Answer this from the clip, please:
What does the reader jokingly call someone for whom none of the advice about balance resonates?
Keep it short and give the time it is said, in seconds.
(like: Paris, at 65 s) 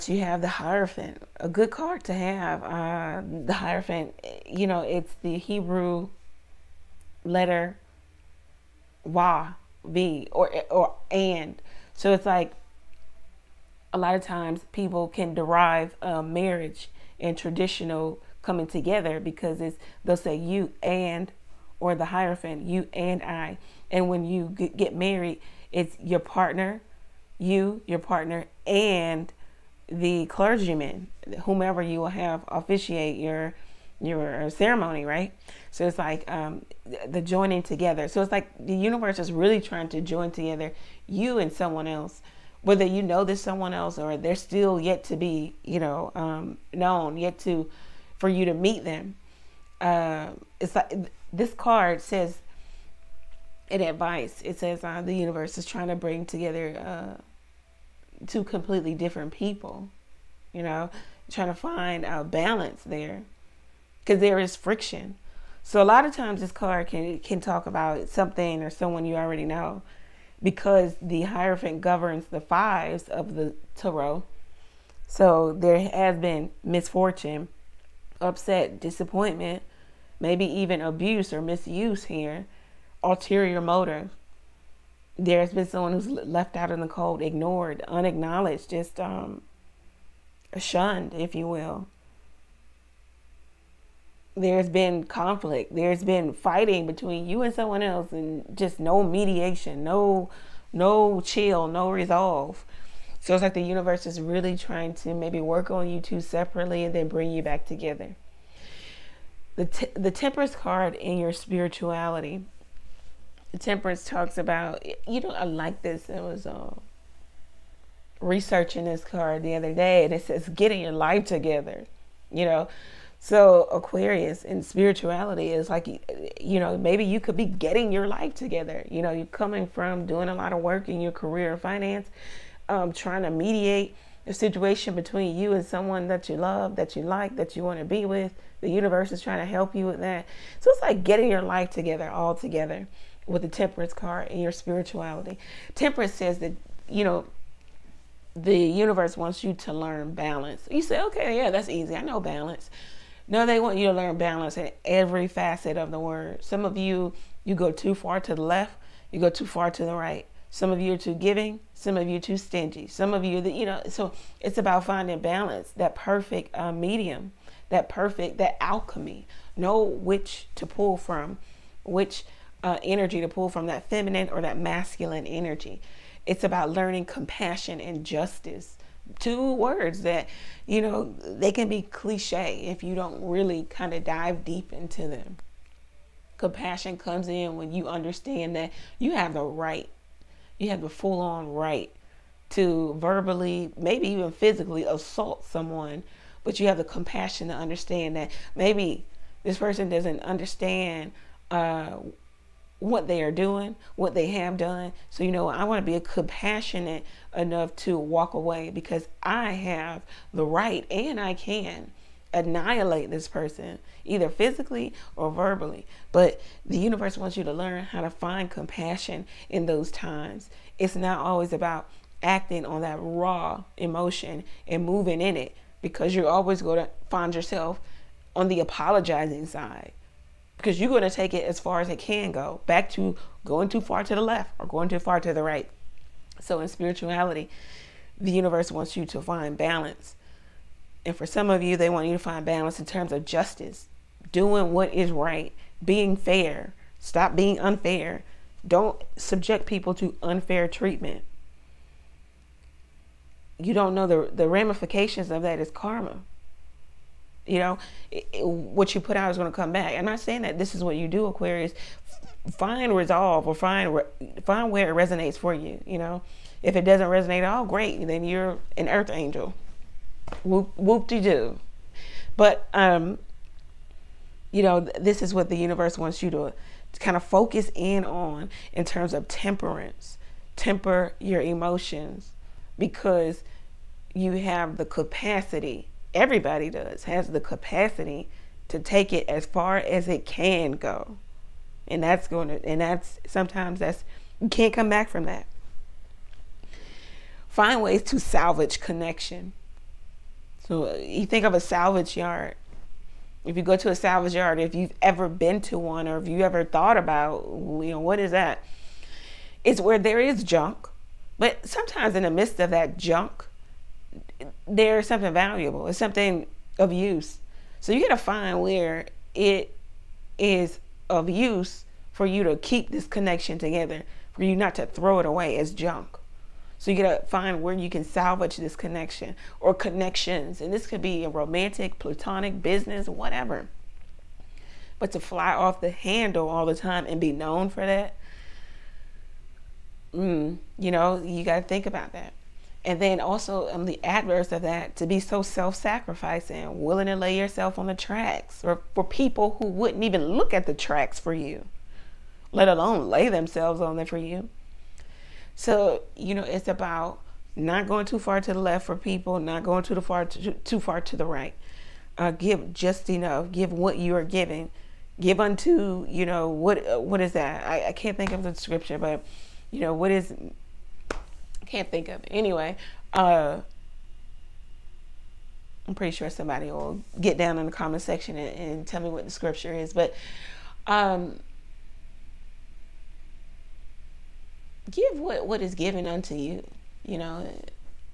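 an earth angel, at 268 s.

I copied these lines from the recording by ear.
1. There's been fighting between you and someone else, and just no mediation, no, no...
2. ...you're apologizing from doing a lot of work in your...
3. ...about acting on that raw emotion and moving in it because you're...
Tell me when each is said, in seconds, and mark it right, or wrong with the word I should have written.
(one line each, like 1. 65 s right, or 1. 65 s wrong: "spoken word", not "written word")
1. 95 s right
2. 129 s wrong: "coming", not "apologizing"
3. 221 s right.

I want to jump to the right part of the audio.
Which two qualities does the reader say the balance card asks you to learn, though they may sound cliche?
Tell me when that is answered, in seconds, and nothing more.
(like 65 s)
177 s.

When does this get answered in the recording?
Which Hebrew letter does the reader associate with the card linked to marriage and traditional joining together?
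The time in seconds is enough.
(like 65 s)
5 s.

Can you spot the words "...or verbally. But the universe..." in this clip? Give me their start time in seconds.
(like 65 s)
215 s.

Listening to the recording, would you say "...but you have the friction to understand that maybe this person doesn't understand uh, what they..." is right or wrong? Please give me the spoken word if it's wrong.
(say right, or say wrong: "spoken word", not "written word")
wrong: "compassion", not "friction".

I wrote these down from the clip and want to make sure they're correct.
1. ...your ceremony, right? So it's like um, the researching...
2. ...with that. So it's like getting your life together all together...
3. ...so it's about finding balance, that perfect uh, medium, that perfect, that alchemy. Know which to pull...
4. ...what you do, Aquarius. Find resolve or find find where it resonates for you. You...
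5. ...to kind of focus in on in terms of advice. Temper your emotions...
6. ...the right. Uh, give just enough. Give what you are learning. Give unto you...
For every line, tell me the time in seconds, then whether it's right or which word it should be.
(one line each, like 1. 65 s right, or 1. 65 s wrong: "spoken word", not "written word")
1. 33 s wrong: "joining", not "researching"
2. 139 s right
3. 163 s right
4. 260 s right
5. 276 s wrong: "temperance", not "advice"
6. 361 s wrong: "giving", not "learning".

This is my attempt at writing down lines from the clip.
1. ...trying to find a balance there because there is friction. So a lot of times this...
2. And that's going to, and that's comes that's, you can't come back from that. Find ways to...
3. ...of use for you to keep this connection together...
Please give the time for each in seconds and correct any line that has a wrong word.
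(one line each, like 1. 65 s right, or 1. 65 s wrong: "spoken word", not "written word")
1. 61 s right
2. 291 s wrong: "sometimes", not "comes"
3. 321 s right.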